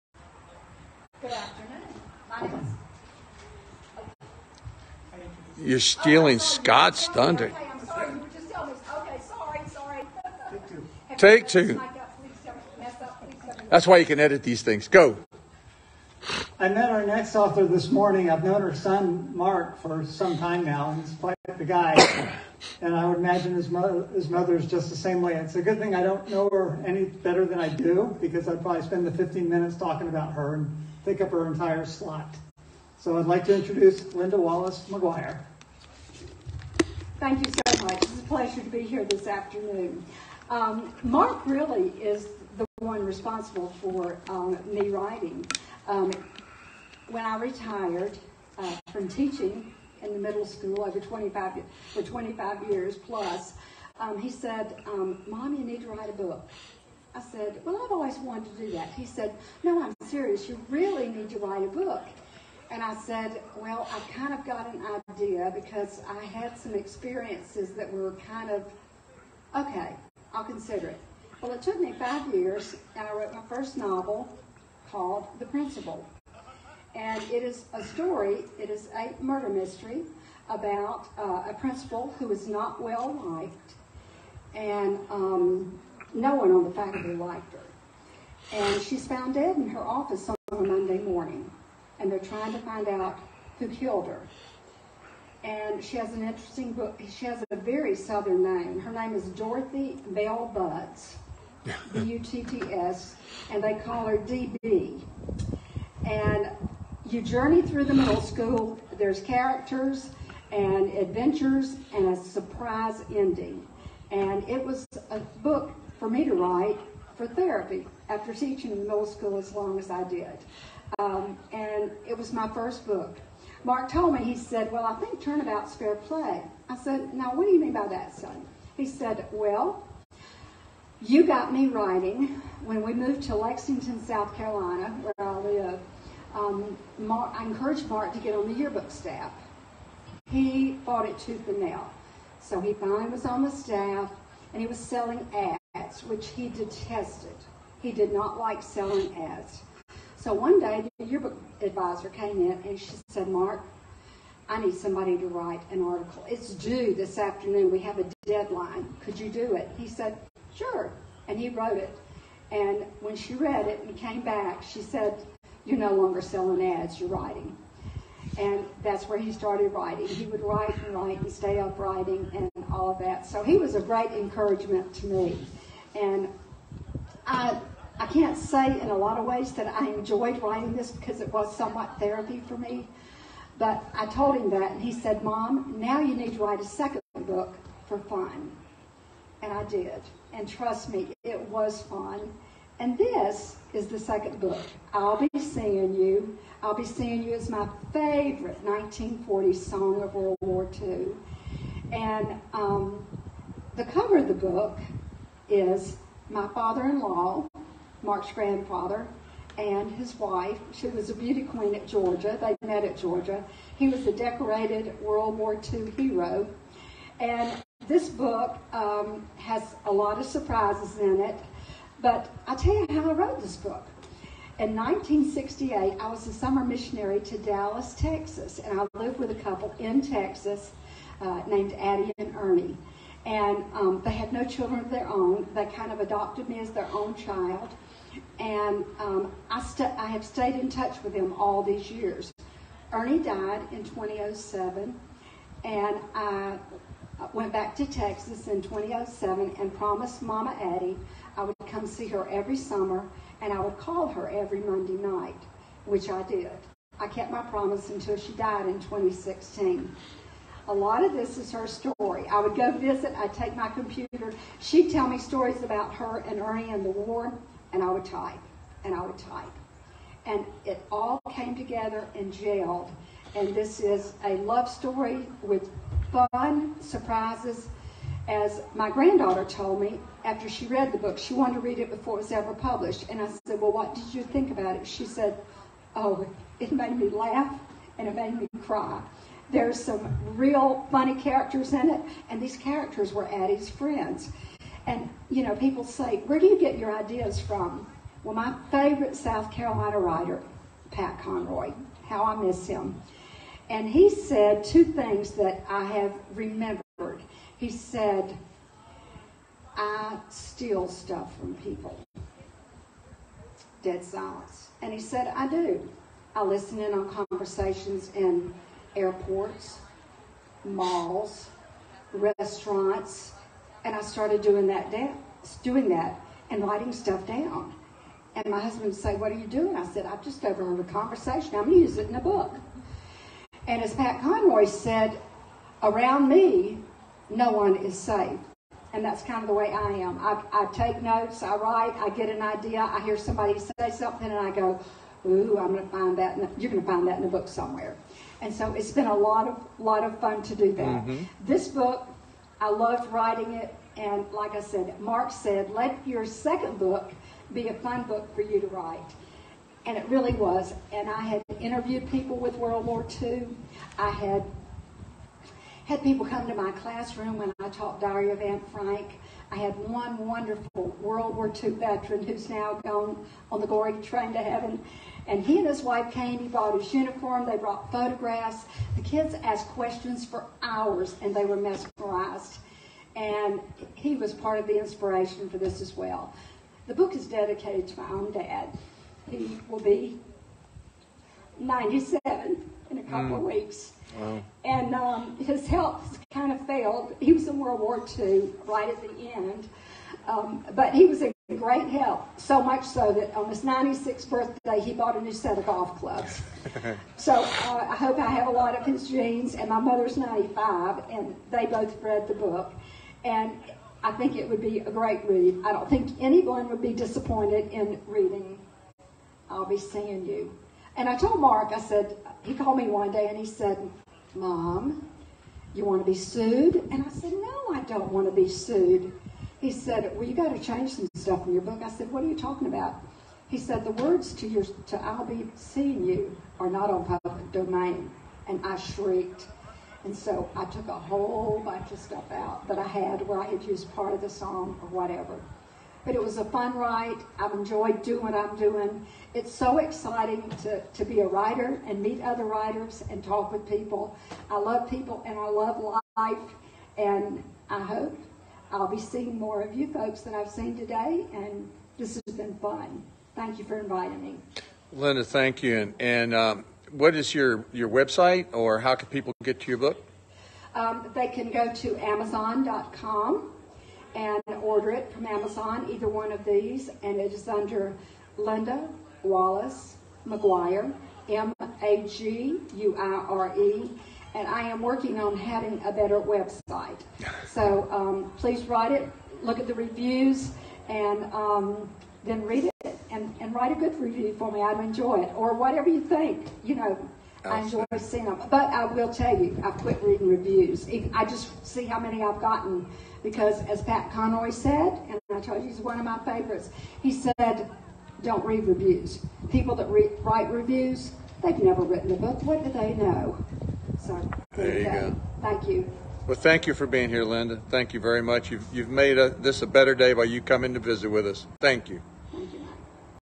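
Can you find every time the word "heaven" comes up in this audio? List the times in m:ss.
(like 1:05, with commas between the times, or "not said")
6:14.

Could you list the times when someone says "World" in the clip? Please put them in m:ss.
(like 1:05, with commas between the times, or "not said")
3:20, 3:35, 6:02, 6:11, 6:37.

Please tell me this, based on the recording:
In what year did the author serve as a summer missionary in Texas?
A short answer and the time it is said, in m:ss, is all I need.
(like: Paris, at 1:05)
1968, at 3:44.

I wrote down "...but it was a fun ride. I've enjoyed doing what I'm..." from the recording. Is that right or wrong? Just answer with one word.
right.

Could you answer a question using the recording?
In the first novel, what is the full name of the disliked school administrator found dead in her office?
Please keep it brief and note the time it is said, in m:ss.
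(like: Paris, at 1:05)
Dorothy Bell Butts, at 1:39.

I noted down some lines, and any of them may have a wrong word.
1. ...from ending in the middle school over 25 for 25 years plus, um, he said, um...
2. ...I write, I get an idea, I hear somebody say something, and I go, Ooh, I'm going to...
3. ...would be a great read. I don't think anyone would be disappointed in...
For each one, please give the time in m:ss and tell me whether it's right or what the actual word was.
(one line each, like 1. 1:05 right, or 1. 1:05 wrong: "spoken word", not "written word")
1. 0:48 wrong: "teaching", not "ending"
2. 5:41 right
3. 6:54 right.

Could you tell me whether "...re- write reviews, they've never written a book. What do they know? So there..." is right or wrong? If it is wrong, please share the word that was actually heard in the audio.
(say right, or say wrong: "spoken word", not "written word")
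right.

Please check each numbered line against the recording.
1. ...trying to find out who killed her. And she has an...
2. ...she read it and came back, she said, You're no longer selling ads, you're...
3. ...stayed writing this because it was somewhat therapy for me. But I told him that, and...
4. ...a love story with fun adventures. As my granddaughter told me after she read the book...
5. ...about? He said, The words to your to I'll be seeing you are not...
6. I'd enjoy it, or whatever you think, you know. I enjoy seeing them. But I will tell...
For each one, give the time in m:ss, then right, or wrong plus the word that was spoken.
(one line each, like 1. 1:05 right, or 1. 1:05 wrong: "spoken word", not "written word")
1. 1:32 right
2. 2:43 right
3. 2:59 wrong: "enjoyed", not "stayed"
4. 4:34 wrong: "surprises", not "adventures"
5. 7:12 right
6. 8:14 right.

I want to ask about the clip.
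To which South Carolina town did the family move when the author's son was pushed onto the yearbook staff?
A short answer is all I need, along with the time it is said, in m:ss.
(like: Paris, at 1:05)
Lexington, at 2:13.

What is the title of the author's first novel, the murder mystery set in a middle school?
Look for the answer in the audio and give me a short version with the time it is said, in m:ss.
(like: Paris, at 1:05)
The Principal, at 1:15.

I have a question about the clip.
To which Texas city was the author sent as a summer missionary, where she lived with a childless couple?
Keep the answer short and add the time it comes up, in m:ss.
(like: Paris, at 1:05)
Dallas, at 3:47.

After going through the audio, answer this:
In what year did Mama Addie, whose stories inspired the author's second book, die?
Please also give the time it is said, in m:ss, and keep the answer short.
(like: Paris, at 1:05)
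2016, at 4:18.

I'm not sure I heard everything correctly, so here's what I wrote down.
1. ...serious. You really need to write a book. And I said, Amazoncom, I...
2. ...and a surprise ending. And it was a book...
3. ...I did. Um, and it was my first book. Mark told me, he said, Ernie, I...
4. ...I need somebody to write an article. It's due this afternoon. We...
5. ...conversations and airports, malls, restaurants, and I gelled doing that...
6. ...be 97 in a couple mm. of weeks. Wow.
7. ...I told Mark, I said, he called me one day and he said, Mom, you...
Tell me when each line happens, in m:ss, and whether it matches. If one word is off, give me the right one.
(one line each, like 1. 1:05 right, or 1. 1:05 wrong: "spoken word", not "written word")
1. 1:00 wrong: "Well", not "Amazoncom"
2. 1:51 right
3. 1:59 wrong: "Well", not "Ernie"
4. 2:34 right
5. 5:17 wrong: "started", not "gelled"
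6. 6:29 right
7. 7:01 right.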